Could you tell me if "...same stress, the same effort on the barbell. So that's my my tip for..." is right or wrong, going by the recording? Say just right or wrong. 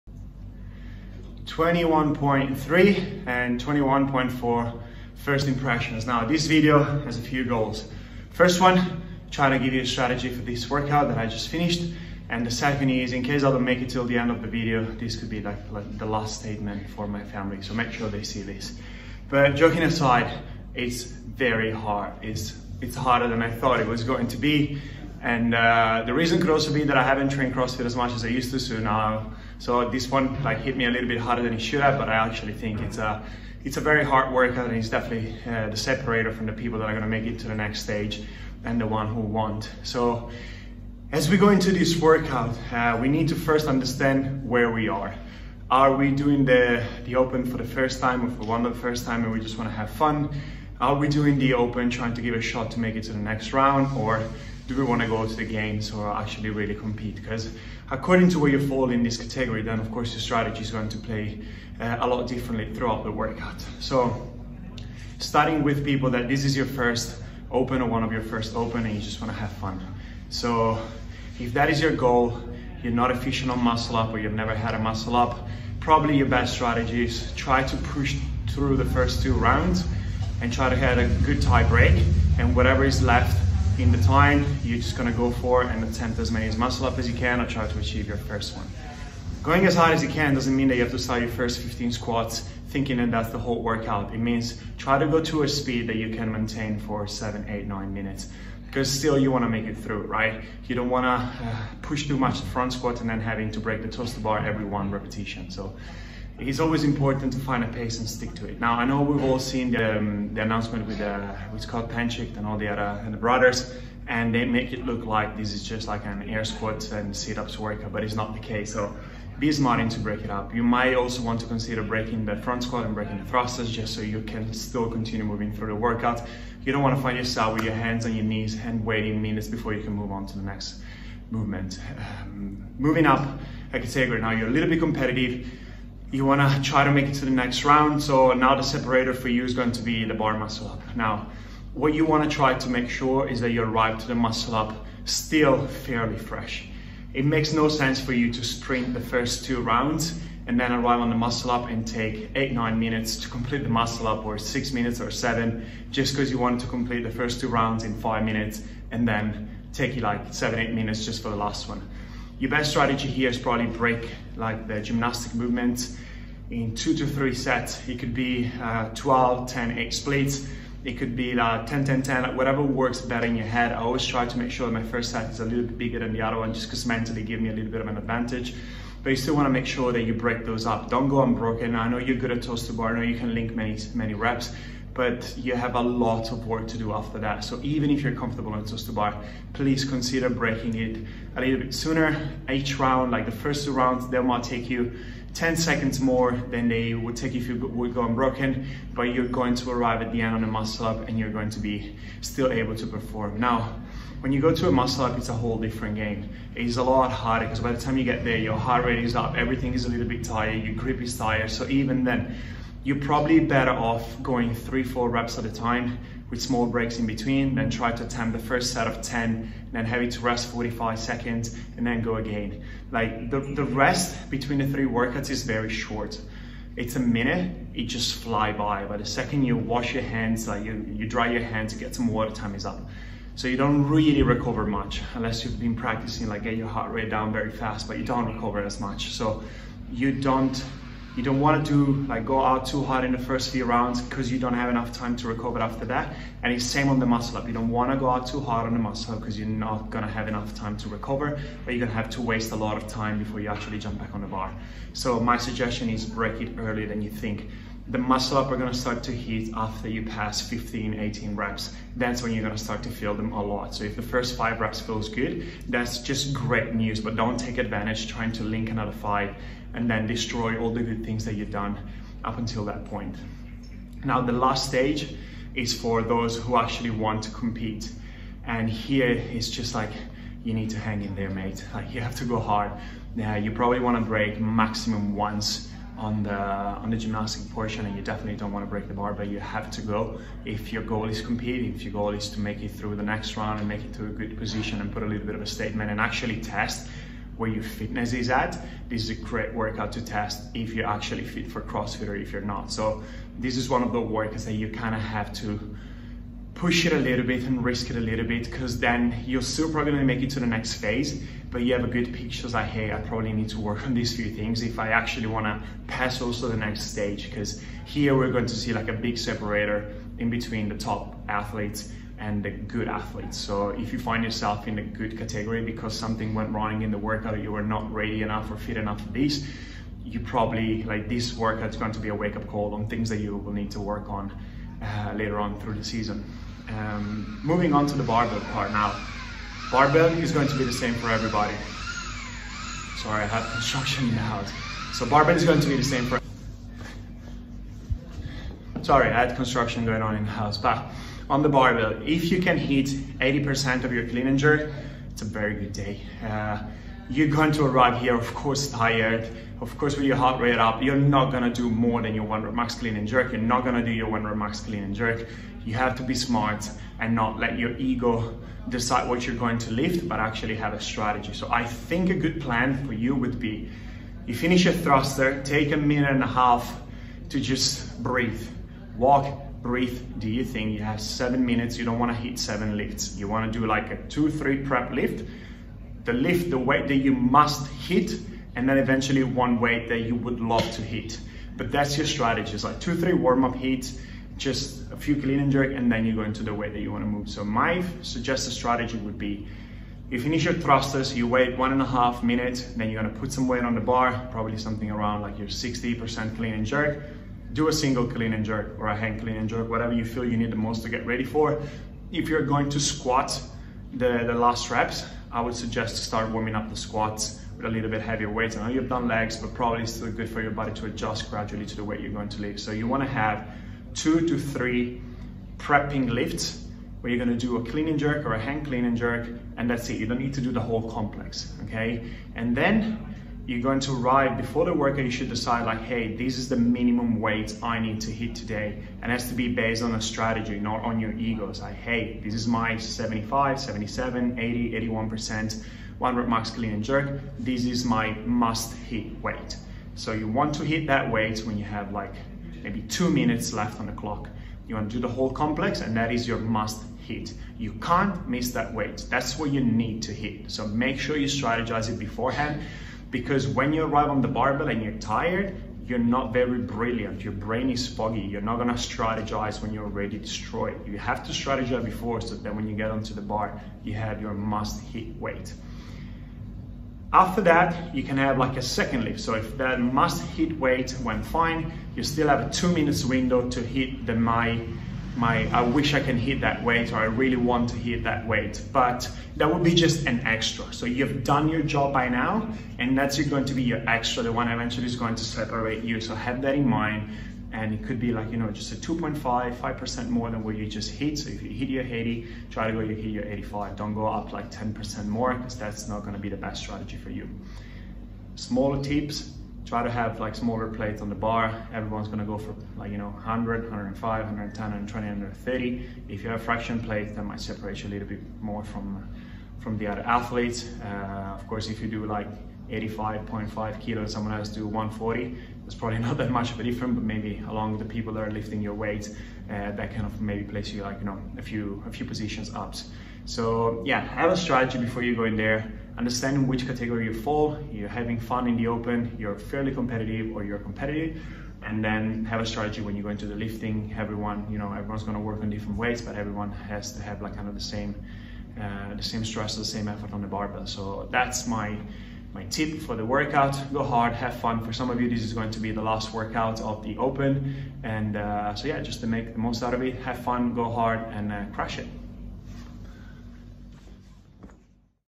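right.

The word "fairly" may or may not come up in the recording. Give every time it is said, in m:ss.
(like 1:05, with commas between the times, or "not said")
2:25, 8:59.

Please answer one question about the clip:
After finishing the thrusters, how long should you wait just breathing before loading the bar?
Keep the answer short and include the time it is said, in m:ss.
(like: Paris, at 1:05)
A minute and a half, at 6:15.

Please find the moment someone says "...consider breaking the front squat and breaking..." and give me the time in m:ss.
2:01.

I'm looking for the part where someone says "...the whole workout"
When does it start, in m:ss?
1:33.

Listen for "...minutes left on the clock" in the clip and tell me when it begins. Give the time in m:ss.
7:33.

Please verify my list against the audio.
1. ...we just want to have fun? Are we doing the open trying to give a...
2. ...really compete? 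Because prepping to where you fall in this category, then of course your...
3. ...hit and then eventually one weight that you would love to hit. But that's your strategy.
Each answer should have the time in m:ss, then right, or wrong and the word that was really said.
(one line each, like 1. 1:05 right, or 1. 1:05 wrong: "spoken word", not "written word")
1. 0:49 right
2. 0:56 wrong: "according", not "prepping"
3. 6:27 right.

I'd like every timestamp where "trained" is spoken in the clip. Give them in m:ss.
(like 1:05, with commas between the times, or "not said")
0:27.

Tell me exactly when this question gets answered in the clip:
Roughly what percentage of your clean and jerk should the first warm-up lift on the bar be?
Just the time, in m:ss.
6:45.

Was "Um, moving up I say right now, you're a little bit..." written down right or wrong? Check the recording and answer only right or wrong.
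right.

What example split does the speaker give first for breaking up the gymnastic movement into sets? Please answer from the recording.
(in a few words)
12, 10, 8.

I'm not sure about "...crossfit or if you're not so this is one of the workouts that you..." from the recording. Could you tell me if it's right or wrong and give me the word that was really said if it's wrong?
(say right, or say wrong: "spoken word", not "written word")
right.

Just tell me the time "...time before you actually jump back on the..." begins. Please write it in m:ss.
4:12.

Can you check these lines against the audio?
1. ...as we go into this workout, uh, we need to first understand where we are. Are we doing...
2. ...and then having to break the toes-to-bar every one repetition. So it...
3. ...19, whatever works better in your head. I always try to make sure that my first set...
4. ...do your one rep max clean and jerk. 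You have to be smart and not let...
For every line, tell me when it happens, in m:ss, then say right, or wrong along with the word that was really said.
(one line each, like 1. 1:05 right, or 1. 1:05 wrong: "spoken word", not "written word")
1. 0:41 right
2. 1:43 right
3. 2:52 wrong: "10", not "19"
4. 6:03 right.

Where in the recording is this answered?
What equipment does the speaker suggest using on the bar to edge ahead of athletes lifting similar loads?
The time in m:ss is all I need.
8:36.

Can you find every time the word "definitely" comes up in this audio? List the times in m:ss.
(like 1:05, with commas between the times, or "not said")
0:34, 4:48.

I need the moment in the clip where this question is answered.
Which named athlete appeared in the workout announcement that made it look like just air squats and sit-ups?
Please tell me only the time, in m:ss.
1:51.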